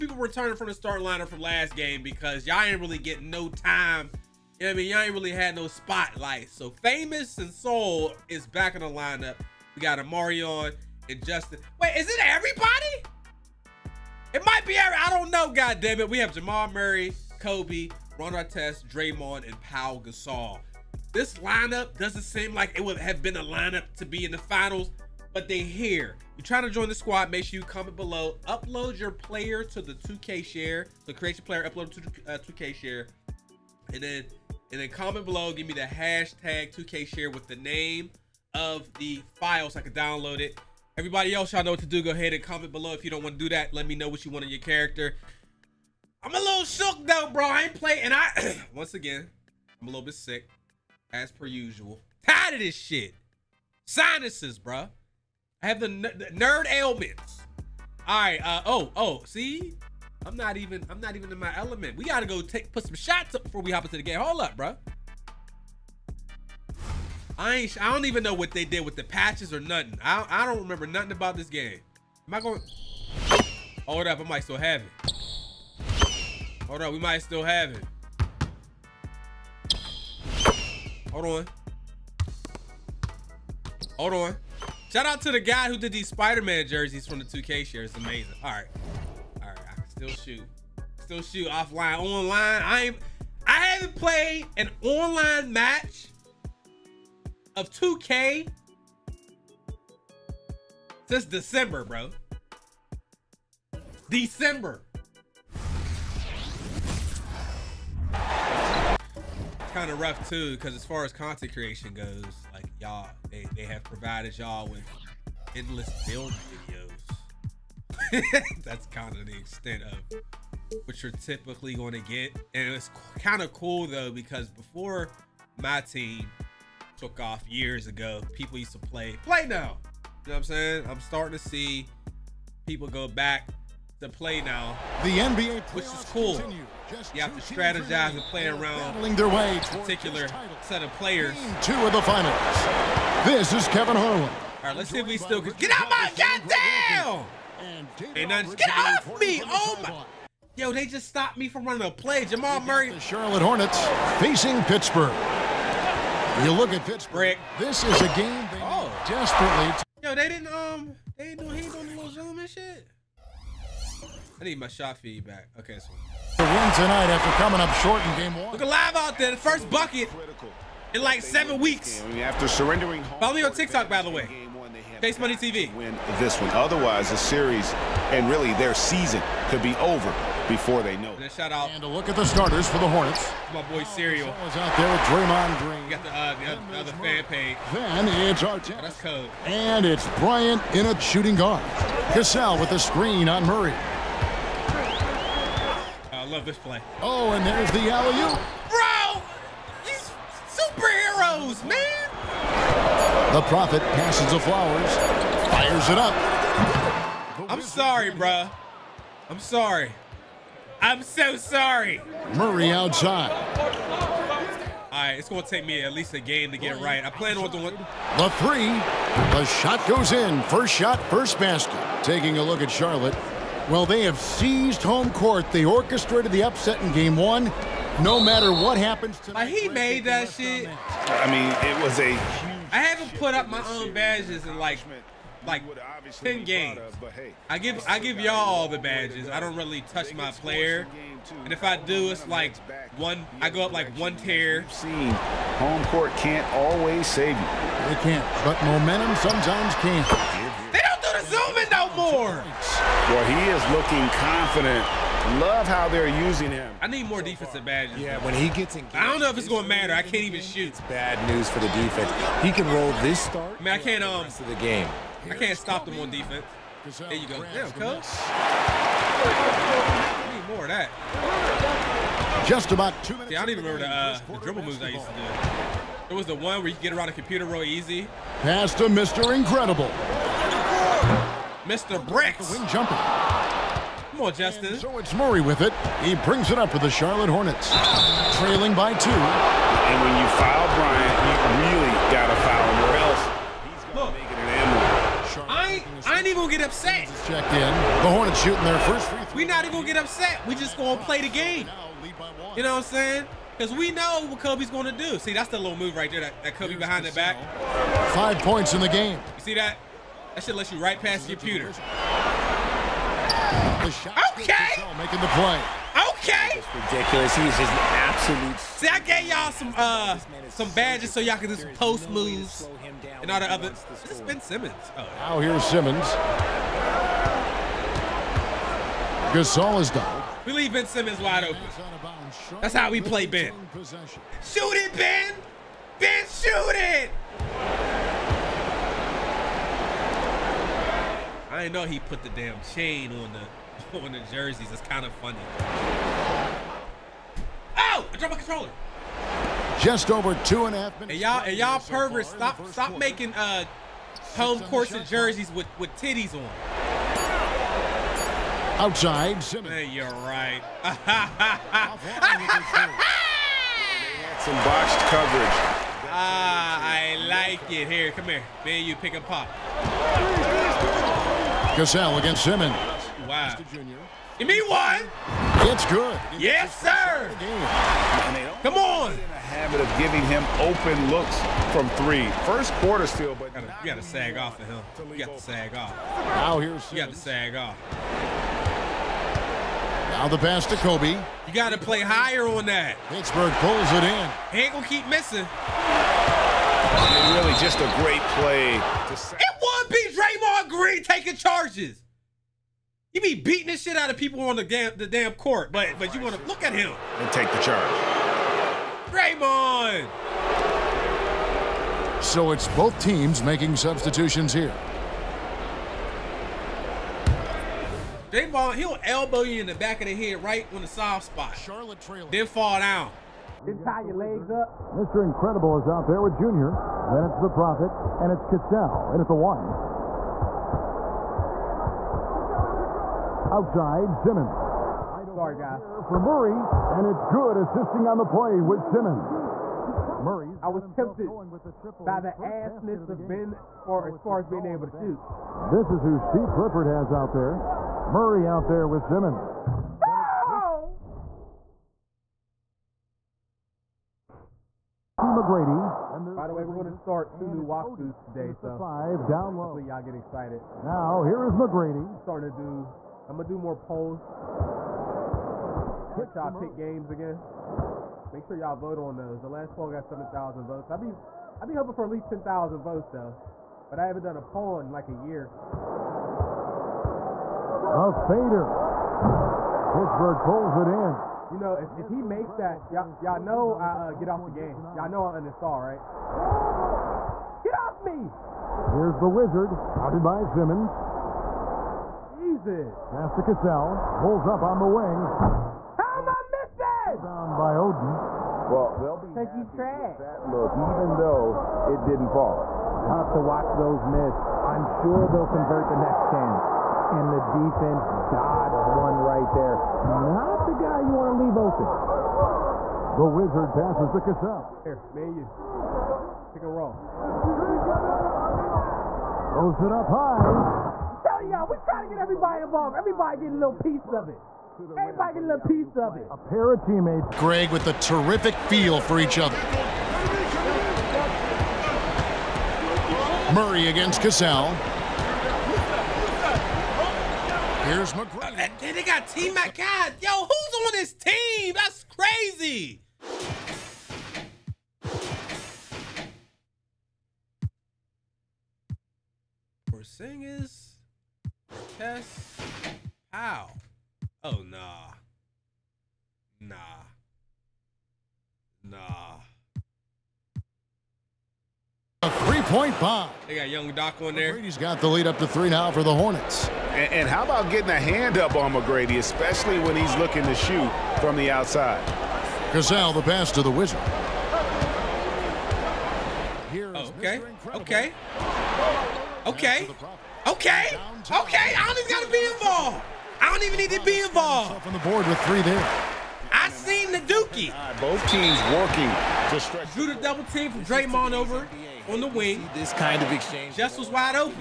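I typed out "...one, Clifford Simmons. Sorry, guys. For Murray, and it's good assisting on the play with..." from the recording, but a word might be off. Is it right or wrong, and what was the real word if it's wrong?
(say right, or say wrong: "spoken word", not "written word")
wrong: "Outside", not "Clifford".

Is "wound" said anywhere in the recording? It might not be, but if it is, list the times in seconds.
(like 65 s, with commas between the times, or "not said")
not said.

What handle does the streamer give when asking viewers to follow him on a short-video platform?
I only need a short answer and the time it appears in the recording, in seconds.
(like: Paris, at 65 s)
Chase Money TV, at 174 s.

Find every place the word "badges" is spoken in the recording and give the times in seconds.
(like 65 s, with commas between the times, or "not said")
233 s, 238 s, 257 s, 320 s.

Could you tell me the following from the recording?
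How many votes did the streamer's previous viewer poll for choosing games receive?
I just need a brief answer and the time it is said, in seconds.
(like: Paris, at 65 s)
7,000, at 470 s.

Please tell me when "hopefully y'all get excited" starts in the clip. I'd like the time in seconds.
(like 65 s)
459 s.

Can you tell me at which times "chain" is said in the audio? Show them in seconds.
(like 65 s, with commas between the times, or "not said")
342 s.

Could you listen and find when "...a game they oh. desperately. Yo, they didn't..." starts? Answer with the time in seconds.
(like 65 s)
158 s.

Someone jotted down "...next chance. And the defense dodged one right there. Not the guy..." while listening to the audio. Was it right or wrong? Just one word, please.
right.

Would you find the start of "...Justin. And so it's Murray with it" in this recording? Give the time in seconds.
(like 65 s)
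284 s.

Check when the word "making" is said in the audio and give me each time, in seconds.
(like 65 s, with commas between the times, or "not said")
314 s, 352 s, 413 s.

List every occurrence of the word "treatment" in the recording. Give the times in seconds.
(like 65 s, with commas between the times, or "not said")
not said.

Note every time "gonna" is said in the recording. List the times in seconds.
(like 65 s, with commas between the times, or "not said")
394 s, 463 s.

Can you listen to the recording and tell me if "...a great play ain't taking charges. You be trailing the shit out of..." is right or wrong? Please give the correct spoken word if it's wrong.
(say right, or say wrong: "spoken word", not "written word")
wrong: "beating", not "trailing".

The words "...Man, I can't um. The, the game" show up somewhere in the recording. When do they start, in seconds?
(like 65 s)
263 s.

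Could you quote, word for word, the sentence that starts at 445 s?
This is who Steve Clifford has out there.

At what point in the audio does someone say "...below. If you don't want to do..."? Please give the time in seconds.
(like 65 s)
42 s.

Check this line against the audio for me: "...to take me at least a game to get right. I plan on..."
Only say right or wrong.
right.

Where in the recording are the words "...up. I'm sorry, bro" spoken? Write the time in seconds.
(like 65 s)
205 s.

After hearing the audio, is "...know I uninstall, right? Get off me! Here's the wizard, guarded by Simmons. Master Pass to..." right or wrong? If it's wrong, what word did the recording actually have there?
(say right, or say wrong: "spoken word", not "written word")
right.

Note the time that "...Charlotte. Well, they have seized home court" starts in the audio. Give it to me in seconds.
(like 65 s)
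222 s.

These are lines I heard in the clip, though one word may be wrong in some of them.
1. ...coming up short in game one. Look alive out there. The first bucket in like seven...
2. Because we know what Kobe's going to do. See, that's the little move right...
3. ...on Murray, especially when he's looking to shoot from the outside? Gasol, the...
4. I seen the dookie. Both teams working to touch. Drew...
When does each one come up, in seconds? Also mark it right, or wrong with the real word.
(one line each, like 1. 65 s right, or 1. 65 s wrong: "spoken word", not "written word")
1. 167 s right
2. 303 s right
3. 568 s wrong: "McGrady", not "Murray"
4. 586 s wrong: "stretch", not "touch".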